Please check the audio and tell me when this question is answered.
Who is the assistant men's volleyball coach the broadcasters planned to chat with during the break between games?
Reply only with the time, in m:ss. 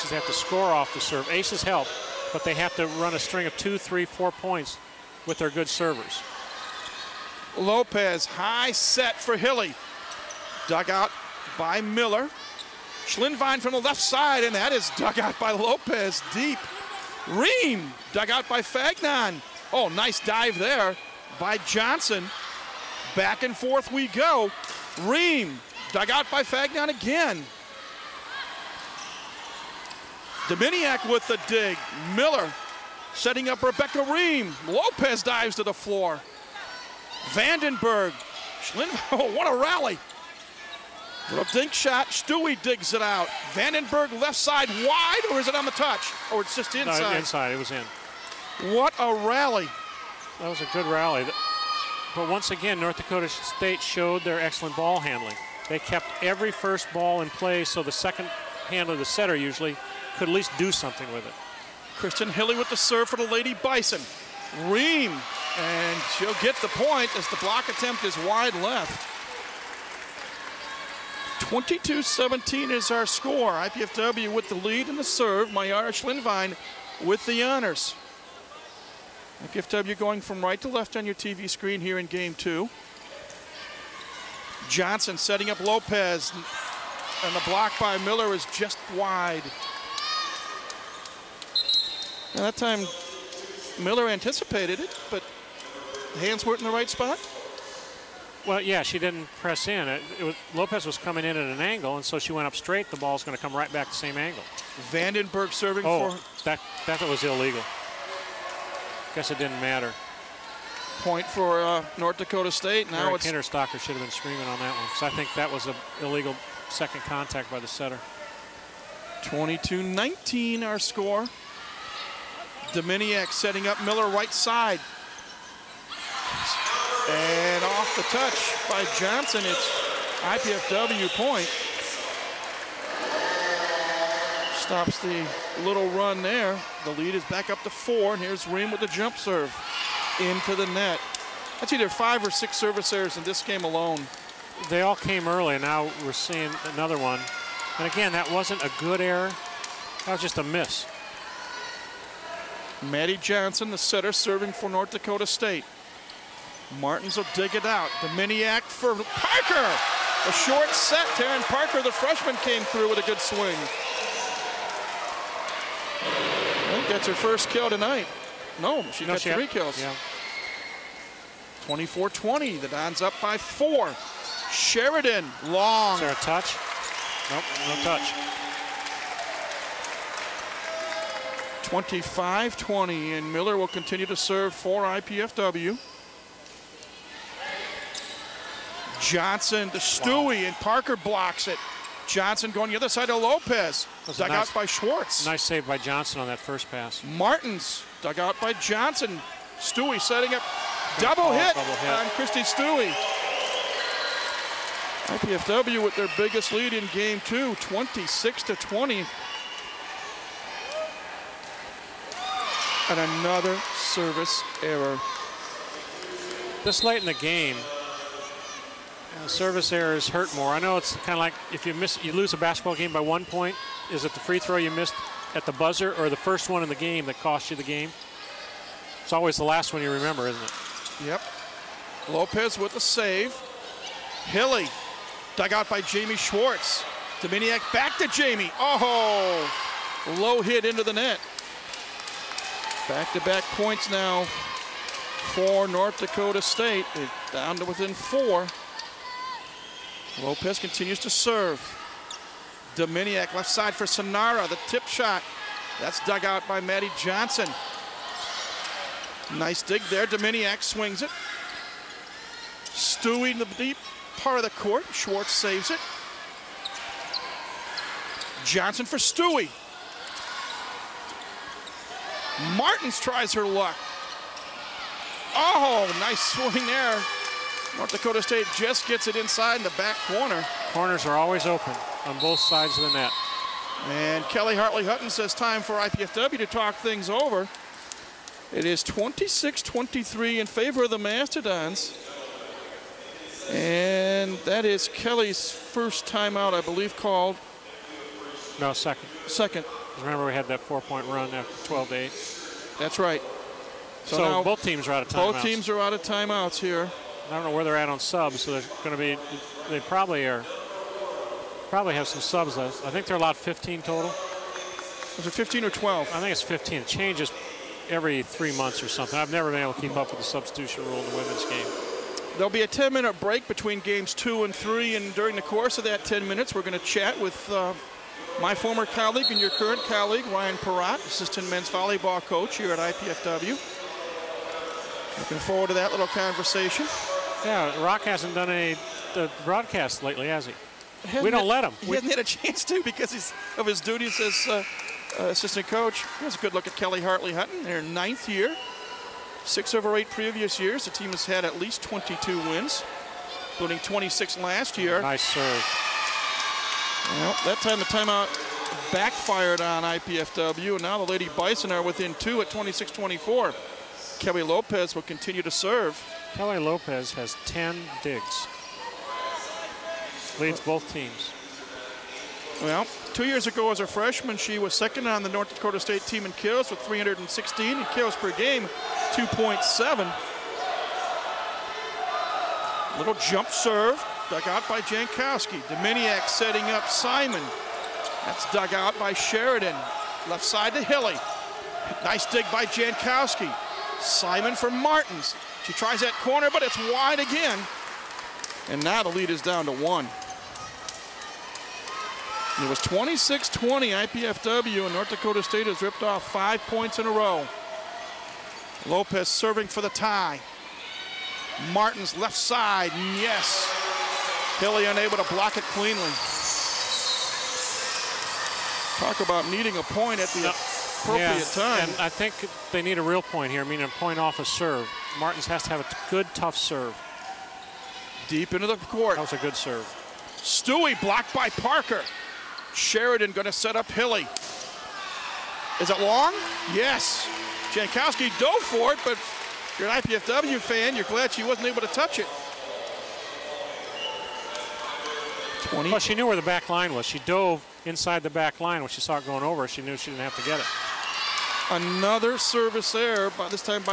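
5:30.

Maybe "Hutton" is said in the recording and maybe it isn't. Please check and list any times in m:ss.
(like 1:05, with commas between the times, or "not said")
4:44, 5:47.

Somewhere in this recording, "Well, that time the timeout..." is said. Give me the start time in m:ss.
5:57.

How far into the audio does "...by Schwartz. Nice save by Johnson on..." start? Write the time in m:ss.
3:14.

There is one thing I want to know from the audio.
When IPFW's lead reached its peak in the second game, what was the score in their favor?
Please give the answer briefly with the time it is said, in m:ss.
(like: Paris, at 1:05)
26-20, at 3:27.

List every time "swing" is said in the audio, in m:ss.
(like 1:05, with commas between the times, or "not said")
2:43, 4:20, 4:36.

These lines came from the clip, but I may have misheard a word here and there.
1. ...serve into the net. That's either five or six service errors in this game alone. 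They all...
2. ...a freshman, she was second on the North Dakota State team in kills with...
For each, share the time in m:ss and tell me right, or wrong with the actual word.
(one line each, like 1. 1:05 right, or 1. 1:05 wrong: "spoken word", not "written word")
1. 2:19 right
2. 6:13 right.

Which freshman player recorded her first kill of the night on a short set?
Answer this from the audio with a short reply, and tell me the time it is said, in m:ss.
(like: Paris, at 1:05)
Taryn Parker, at 2:41.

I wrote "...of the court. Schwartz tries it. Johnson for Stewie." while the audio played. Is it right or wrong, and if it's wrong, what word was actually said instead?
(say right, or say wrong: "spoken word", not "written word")
wrong: "saves", not "tries".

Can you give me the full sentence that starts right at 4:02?
Back-to-back -back points now for North Dakota State.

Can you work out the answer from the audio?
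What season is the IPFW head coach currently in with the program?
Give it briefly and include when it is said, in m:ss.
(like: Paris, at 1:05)
ninth year, at 5:47.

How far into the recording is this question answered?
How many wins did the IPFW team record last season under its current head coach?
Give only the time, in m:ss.
5:53.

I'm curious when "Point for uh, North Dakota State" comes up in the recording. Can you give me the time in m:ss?
1:51.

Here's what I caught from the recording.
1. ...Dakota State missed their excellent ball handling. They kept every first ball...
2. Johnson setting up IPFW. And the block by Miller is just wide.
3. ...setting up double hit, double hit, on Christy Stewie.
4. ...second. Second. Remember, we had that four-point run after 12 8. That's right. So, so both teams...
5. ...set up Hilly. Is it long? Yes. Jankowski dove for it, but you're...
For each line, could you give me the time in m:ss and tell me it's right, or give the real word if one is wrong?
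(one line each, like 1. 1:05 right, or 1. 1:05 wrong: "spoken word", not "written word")
1. 0:52 wrong: "showed", not "missed"
2. 1:24 wrong: "Lopez", not "IPFW"
3. 3:19 right
4. 4:58 right
5. 7:13 right.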